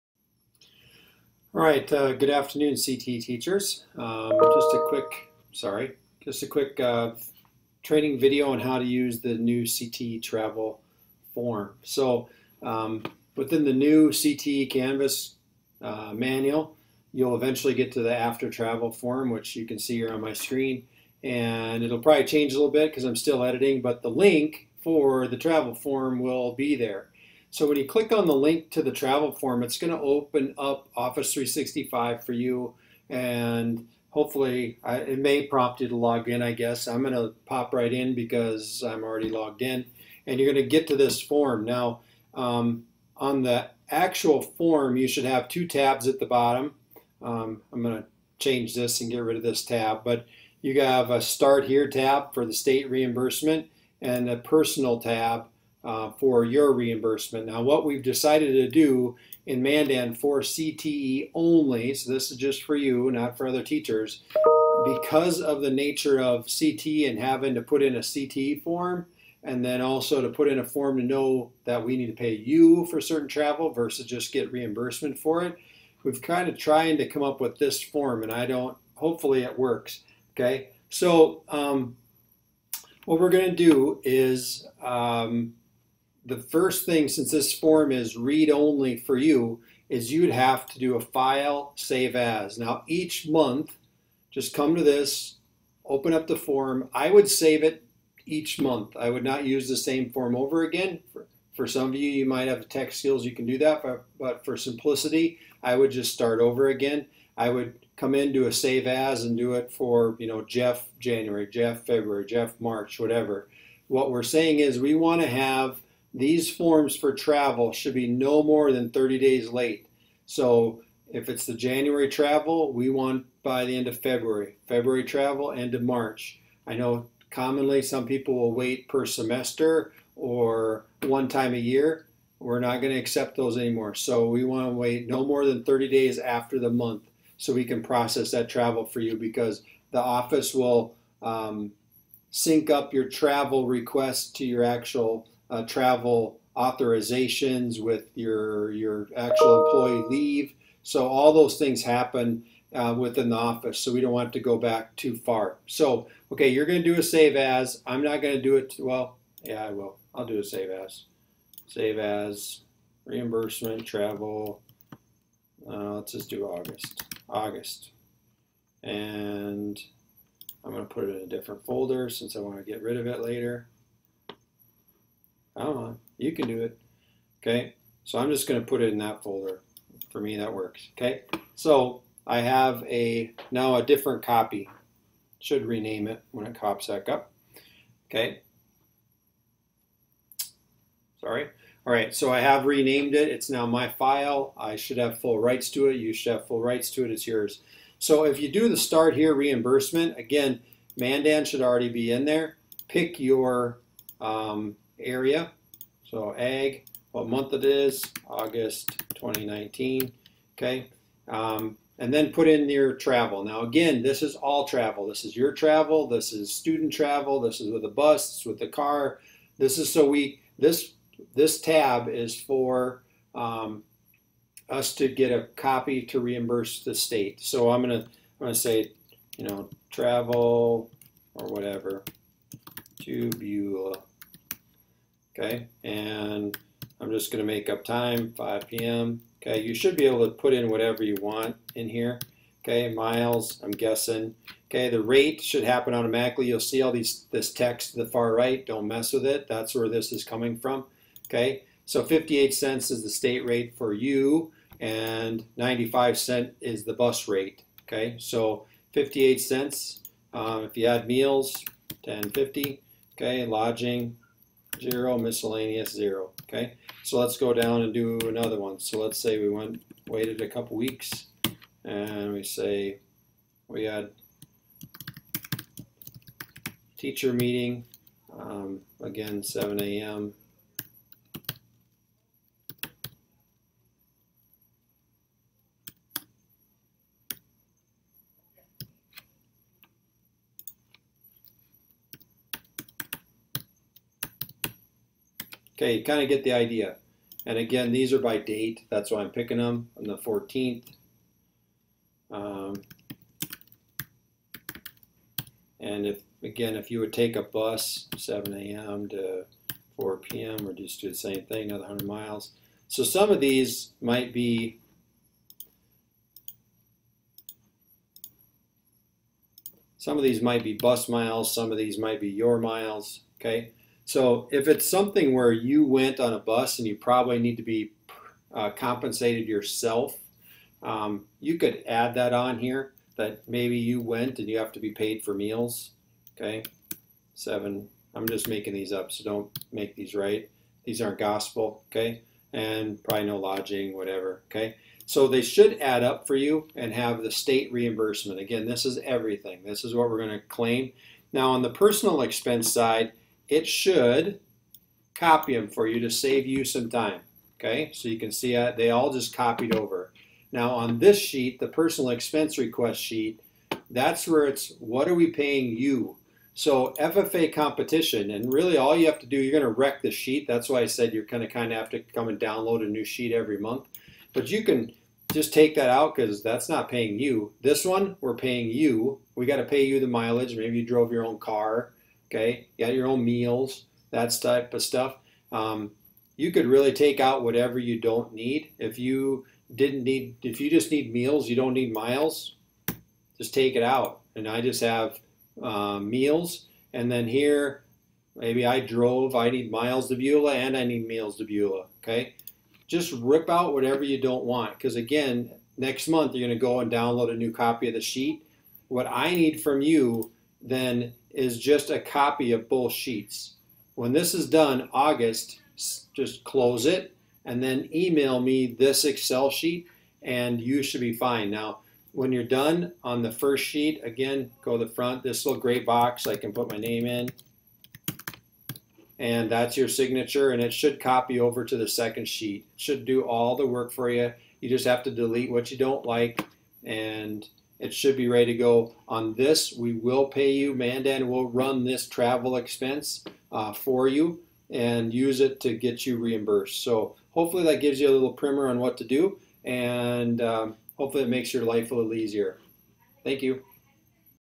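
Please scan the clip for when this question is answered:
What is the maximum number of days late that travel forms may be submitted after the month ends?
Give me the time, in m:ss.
1:58.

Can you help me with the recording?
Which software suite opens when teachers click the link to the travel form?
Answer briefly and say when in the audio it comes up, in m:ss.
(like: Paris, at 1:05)
Office 365, at 0:30.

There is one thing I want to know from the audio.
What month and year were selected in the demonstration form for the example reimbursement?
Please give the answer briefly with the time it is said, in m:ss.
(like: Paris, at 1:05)
August 2019, at 3:28.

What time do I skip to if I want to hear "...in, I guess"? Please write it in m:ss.
0:36.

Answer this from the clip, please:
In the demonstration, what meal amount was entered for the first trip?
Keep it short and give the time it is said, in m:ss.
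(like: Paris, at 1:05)
10.50, at 4:22.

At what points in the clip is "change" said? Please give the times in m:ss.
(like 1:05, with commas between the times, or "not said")
0:22, 0:48.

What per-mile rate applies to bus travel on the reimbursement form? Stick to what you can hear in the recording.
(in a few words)
95 cents.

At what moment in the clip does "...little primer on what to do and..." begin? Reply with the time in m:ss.
7:28.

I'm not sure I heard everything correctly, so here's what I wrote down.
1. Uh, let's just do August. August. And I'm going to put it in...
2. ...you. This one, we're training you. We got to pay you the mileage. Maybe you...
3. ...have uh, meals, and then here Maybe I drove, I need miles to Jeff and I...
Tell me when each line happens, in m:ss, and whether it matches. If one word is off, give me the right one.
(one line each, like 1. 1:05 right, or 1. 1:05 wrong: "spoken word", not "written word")
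1. 2:45 right
2. 6:17 wrong: "paying", not "training"
3. 6:34 wrong: "Beulah", not "Jeff".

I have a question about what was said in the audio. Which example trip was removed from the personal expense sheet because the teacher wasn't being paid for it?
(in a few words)
FFA competition.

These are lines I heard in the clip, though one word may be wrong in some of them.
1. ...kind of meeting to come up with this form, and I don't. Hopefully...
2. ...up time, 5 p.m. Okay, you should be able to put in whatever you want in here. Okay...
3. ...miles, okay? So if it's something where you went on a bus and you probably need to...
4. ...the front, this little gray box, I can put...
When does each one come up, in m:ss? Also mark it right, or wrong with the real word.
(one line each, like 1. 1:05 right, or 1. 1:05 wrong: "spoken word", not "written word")
1. 1:16 wrong: "trying", not "meeting"
2. 3:57 right
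3. 5:22 right
4. 7:04 right.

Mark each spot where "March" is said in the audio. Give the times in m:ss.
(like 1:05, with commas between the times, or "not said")
1:52, 2:05.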